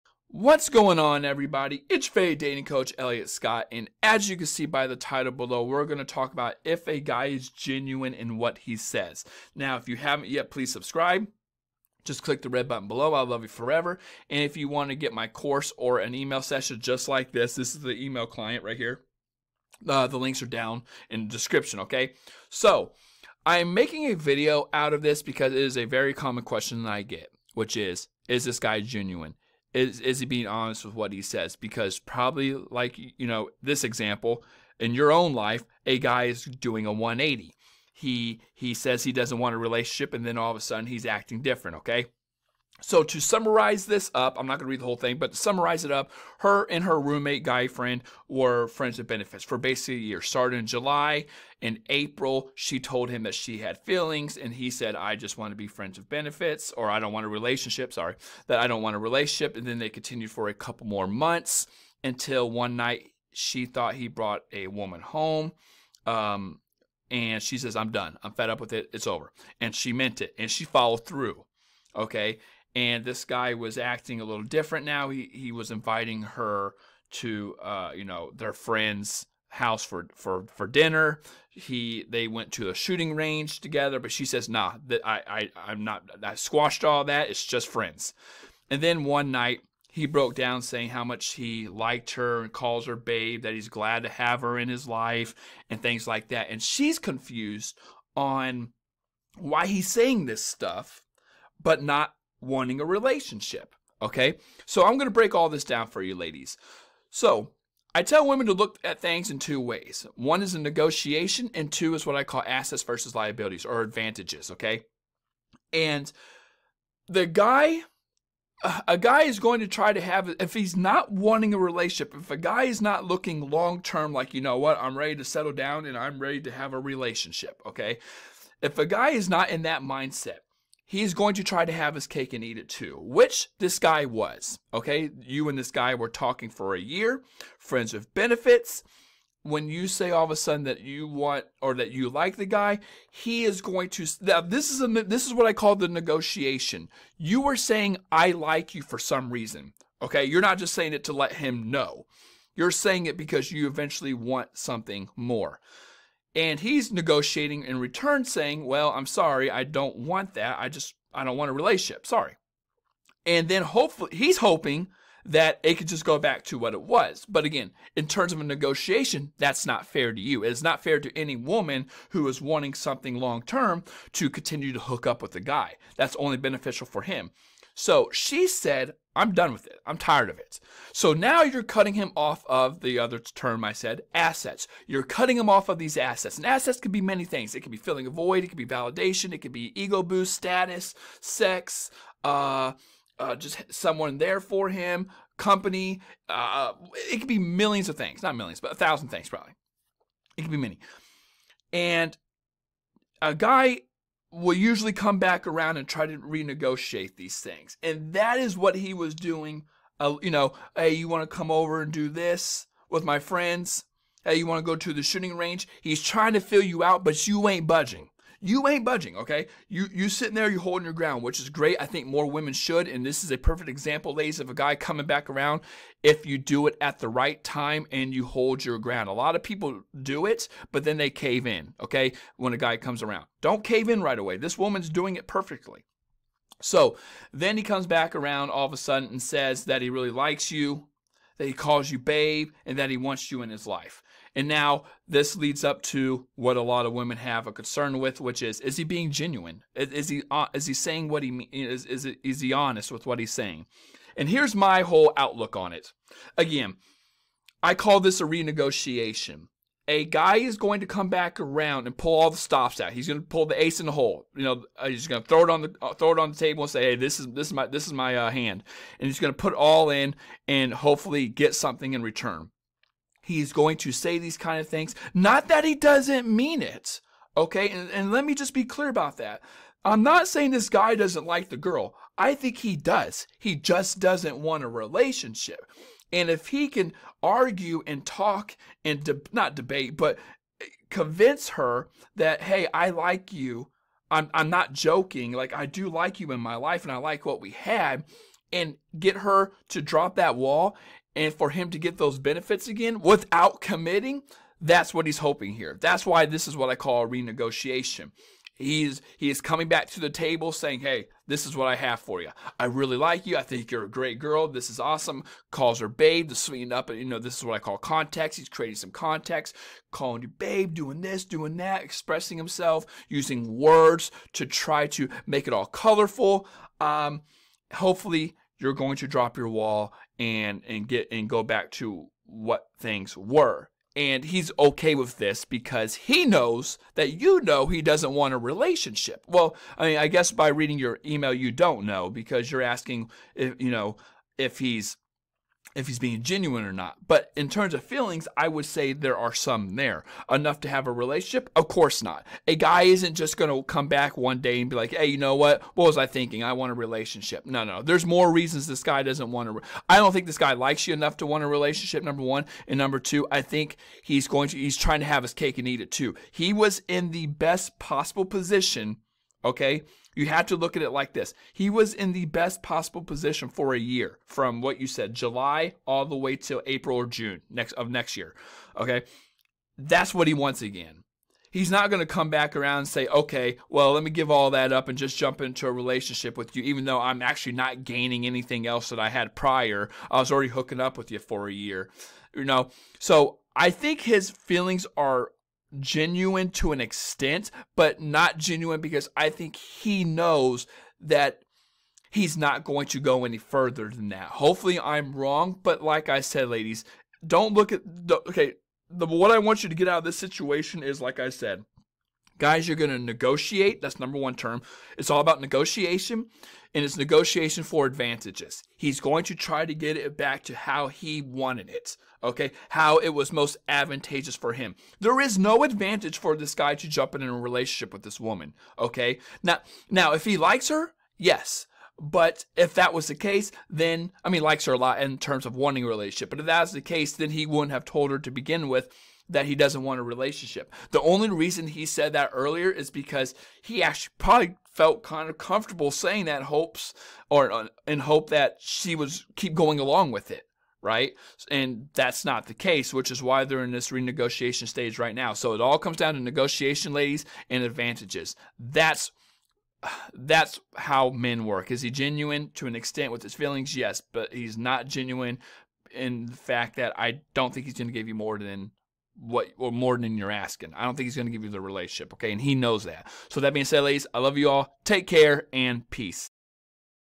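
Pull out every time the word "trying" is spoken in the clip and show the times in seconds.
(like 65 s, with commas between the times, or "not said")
216 s, 364 s.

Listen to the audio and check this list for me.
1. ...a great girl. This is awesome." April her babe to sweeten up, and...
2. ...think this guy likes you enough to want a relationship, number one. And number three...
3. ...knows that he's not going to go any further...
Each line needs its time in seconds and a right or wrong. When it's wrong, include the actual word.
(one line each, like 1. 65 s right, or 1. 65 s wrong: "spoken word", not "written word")
1. 313 s wrong: "Calls", not "April"
2. 360 s wrong: "two", not "three"
3. 400 s right.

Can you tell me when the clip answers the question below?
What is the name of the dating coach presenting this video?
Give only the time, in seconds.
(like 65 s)
2 s.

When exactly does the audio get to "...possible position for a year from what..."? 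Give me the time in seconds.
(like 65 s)
372 s.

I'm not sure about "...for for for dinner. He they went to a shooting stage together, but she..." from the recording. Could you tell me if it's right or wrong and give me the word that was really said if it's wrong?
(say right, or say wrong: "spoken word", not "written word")
wrong: "range", not "stage".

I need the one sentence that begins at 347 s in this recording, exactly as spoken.
But in terms of feelings, I would say there are some there.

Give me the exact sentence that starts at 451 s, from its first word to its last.
And that's not the case, which is why they're in this renegotiation stage right now.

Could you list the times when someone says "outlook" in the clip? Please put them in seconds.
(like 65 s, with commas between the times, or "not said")
255 s.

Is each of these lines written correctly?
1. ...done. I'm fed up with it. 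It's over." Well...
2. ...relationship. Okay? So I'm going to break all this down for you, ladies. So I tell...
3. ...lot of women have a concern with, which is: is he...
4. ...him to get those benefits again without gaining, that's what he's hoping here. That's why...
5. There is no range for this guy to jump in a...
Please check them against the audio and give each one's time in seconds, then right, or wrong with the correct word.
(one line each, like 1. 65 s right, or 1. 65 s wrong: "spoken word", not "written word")
1. 67 s wrong: "And", not "Well"
2. 102 s right
3. 246 s right
4. 301 s wrong: "committing", not "gaining"
5. 424 s wrong: "advantage", not "range".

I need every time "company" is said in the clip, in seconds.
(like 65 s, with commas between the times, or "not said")
195 s.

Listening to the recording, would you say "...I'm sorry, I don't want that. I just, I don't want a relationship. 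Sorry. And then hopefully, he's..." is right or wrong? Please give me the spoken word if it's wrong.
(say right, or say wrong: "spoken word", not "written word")
right.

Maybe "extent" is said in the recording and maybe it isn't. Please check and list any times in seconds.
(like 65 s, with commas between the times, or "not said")
396 s, 462 s.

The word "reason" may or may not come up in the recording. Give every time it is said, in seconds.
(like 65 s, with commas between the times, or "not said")
149 s, 358 s, 441 s.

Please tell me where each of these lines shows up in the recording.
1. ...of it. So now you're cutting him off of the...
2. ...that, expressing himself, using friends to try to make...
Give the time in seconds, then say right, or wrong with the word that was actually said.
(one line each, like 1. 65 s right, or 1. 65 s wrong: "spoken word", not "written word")
1. 180 s right
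2. 321 s wrong: "words", not "friends".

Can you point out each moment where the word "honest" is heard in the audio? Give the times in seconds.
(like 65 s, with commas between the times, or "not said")
30 s, 252 s.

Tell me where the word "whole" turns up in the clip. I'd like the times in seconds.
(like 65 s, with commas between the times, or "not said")
44 s, 254 s.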